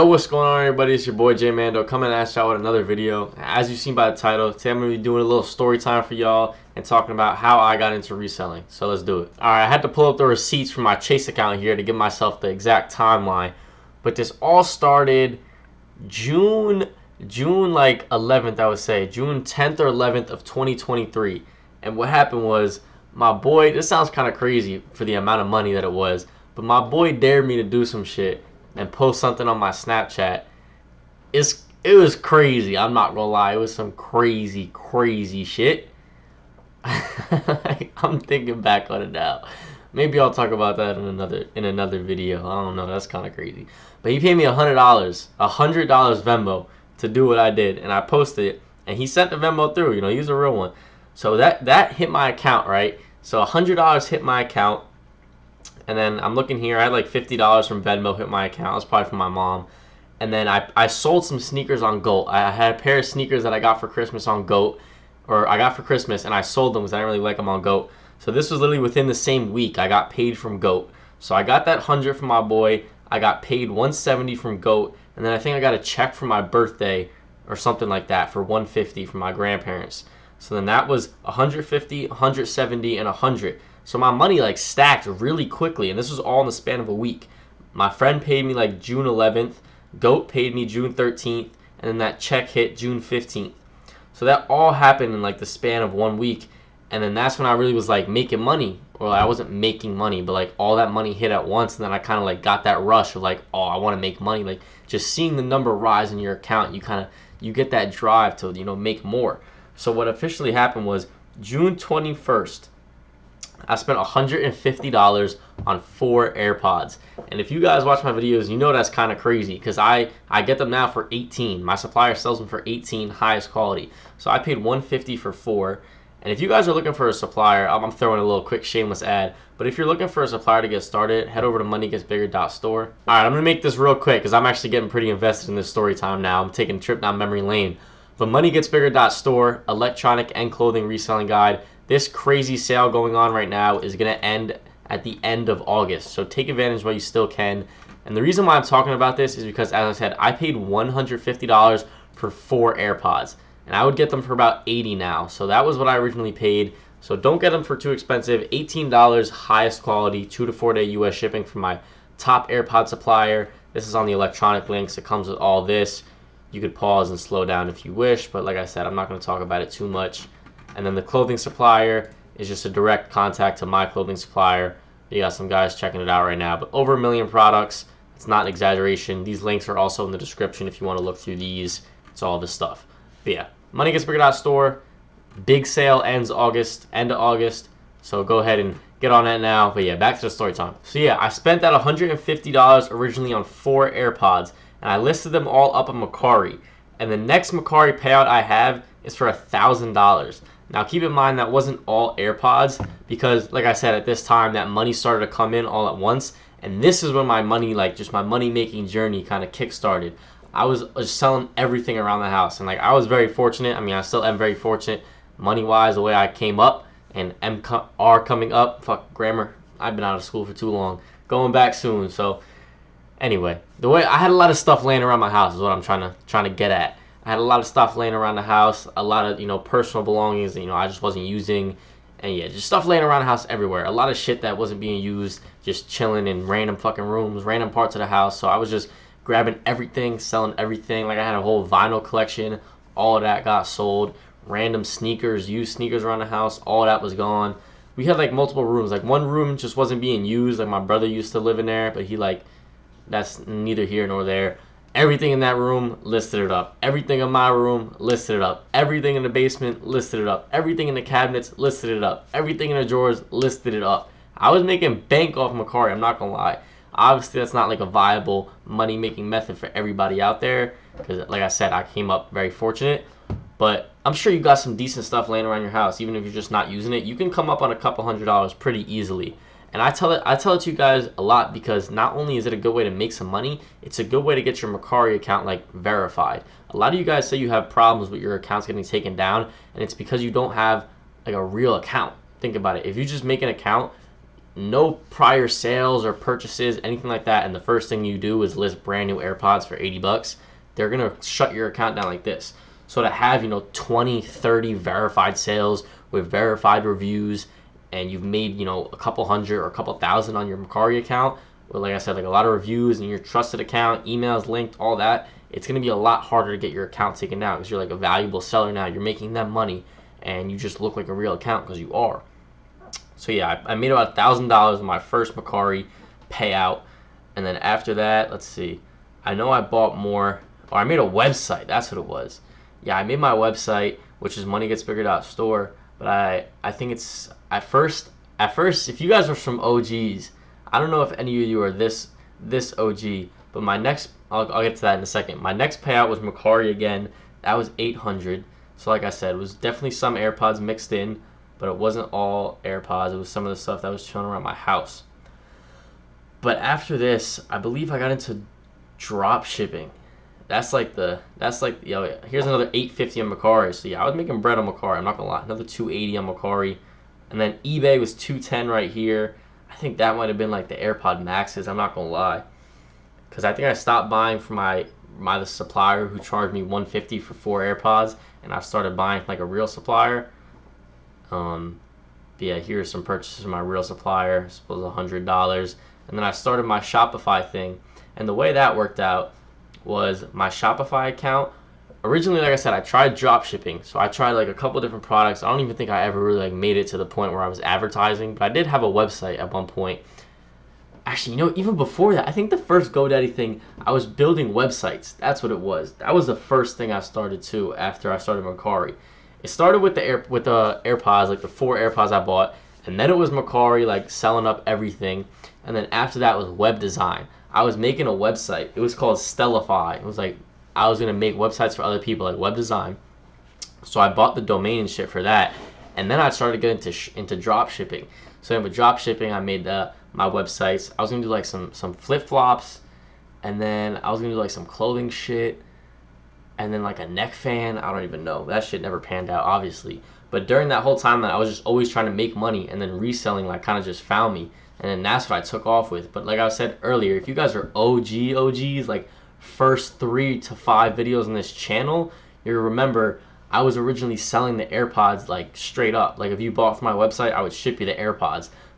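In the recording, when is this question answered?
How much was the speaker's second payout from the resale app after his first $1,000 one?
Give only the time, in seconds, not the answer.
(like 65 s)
347 s.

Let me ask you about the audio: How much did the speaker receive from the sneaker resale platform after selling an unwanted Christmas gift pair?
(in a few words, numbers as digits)
$170.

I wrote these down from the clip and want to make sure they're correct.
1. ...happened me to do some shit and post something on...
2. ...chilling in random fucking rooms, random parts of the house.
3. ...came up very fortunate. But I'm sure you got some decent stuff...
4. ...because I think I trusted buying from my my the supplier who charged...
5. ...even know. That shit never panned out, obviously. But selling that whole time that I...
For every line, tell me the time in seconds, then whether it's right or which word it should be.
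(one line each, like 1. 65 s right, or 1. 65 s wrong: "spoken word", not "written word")
1. 27 s wrong: "dared", not "happened"
2. 235 s right
3. 271 s right
4. 373 s wrong: "stopped", not "trusted"
5. 438 s wrong: "during", not "selling".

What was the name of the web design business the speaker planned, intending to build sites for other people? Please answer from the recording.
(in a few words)
Stellify.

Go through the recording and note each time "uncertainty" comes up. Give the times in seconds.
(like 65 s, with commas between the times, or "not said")
not said.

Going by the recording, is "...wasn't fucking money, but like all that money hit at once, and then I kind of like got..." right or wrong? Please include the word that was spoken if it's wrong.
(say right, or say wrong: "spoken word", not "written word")
wrong: "making", not "fucking".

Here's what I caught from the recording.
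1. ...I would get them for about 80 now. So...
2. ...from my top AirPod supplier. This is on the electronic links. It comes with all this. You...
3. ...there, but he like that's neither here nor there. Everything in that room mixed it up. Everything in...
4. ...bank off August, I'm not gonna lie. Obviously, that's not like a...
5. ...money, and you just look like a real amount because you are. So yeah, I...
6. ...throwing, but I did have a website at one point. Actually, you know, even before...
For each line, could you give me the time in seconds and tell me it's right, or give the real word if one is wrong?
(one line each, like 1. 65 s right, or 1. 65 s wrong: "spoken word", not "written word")
1. 153 s right
2. 161 s right
3. 251 s wrong: "listed", not "mixed"
4. 265 s wrong: "Mercari", not "August"
5. 319 s wrong: "account", not "amount"
6. 397 s wrong: "advertising", not "throwing".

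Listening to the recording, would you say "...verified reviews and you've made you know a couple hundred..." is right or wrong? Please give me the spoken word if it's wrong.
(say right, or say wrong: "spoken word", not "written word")
right.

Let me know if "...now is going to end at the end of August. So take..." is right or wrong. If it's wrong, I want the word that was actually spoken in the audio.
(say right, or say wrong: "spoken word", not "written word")
right.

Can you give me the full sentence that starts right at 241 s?
Like I had a whole vinyl collection, all that got sold.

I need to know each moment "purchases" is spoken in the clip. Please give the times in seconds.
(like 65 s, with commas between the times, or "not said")
296 s, 383 s.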